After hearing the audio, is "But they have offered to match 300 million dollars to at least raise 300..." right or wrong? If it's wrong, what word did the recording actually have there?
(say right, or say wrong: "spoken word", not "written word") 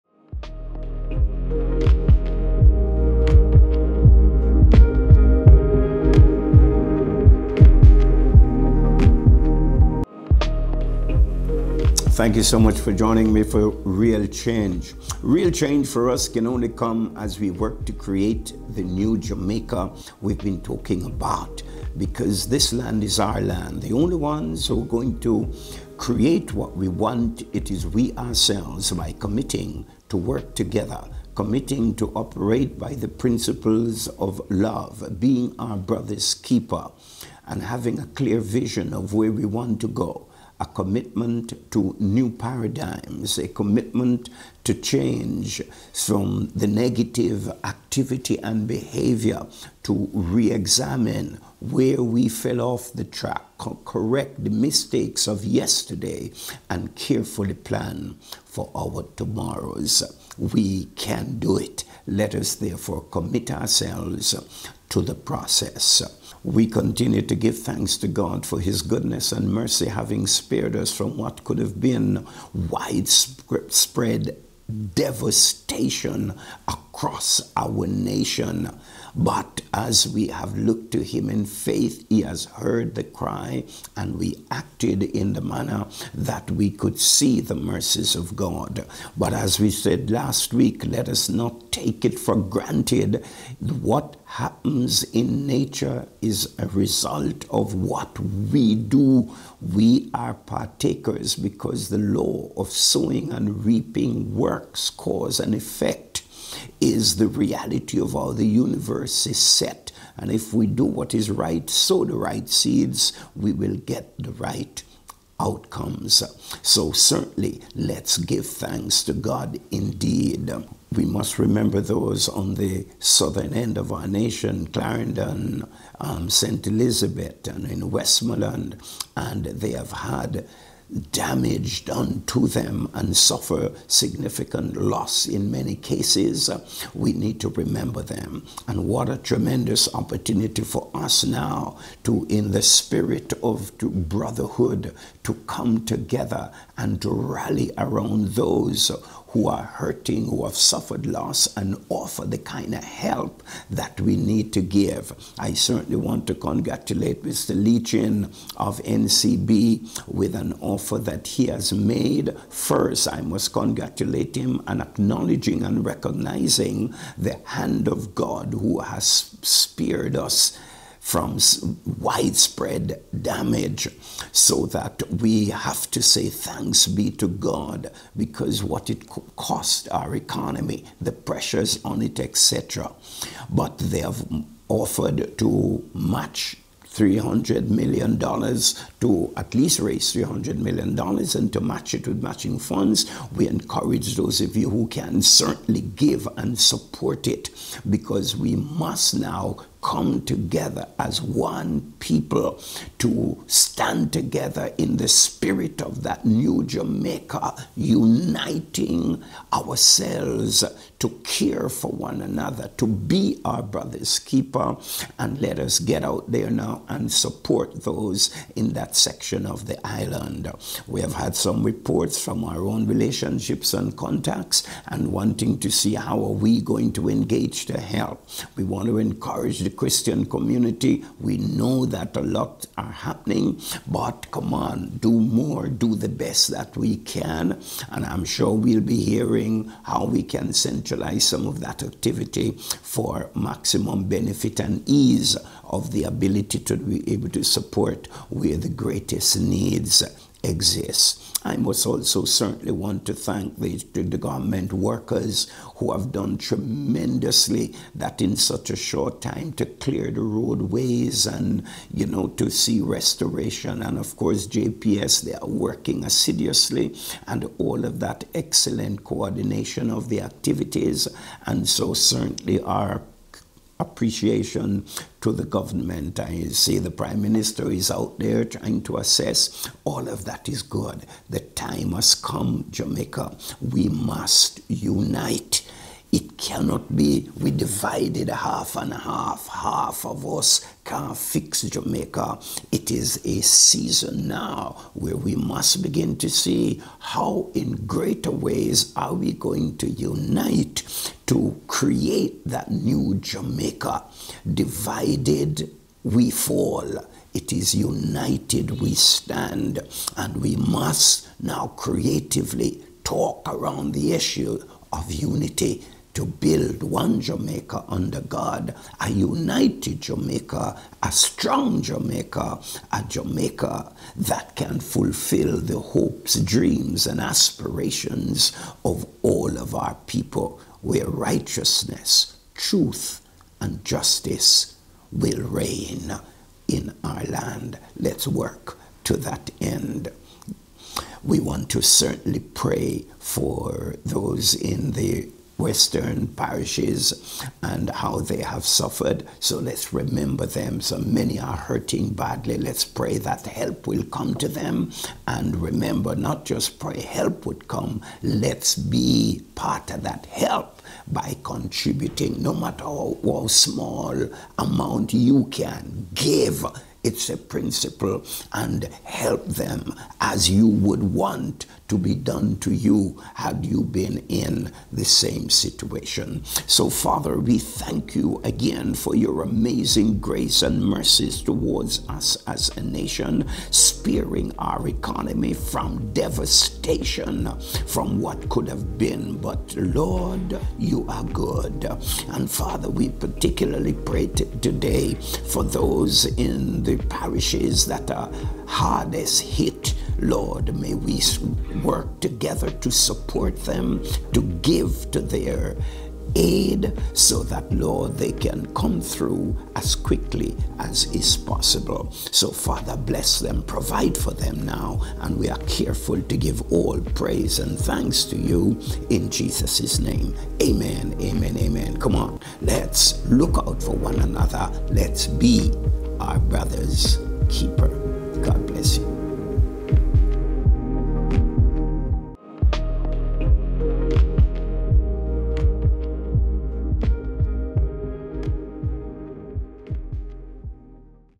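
right.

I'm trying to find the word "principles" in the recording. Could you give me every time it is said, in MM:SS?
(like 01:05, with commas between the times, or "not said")
00:33, 06:07.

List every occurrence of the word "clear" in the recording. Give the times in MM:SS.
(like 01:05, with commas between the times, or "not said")
00:38, 04:19.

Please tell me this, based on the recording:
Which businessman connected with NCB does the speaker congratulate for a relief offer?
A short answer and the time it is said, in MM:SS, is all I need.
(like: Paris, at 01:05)
Mr. Lee-Chin, at 02:37.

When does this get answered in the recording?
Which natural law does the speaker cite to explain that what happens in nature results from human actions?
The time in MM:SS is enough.
01:42.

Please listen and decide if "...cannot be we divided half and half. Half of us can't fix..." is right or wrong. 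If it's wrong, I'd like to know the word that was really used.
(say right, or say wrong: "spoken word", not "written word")
right.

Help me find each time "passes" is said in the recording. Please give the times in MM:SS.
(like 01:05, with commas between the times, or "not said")
not said.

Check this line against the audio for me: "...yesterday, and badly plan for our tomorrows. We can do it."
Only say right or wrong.
wrong.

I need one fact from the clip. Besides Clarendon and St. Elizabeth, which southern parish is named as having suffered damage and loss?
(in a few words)
Westmoreland.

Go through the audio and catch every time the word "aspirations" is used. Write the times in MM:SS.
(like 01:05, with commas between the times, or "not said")
05:27.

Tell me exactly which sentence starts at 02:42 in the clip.
First, I must congratulate him and acknowledging and recognizing the hand of God who has spared us from widespread damage.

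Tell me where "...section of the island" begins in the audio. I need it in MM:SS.
03:38.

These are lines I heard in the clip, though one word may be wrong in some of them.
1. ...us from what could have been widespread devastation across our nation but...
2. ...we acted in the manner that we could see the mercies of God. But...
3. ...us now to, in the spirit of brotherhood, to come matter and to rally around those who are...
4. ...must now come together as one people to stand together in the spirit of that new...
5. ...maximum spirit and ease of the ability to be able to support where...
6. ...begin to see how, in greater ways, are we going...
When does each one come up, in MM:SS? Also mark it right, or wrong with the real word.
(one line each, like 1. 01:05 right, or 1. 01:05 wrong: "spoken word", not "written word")
1. 01:10 right
2. 01:24 right
3. 02:20 wrong: "together", not "matter"
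4. 03:18 right
5. 04:03 wrong: "benefit", not "spirit"
6. 04:55 right.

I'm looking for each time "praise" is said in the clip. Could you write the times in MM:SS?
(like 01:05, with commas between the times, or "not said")
06:57.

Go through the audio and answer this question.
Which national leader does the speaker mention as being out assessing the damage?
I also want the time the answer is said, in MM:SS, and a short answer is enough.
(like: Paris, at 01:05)
the Prime Minister, at 04:36.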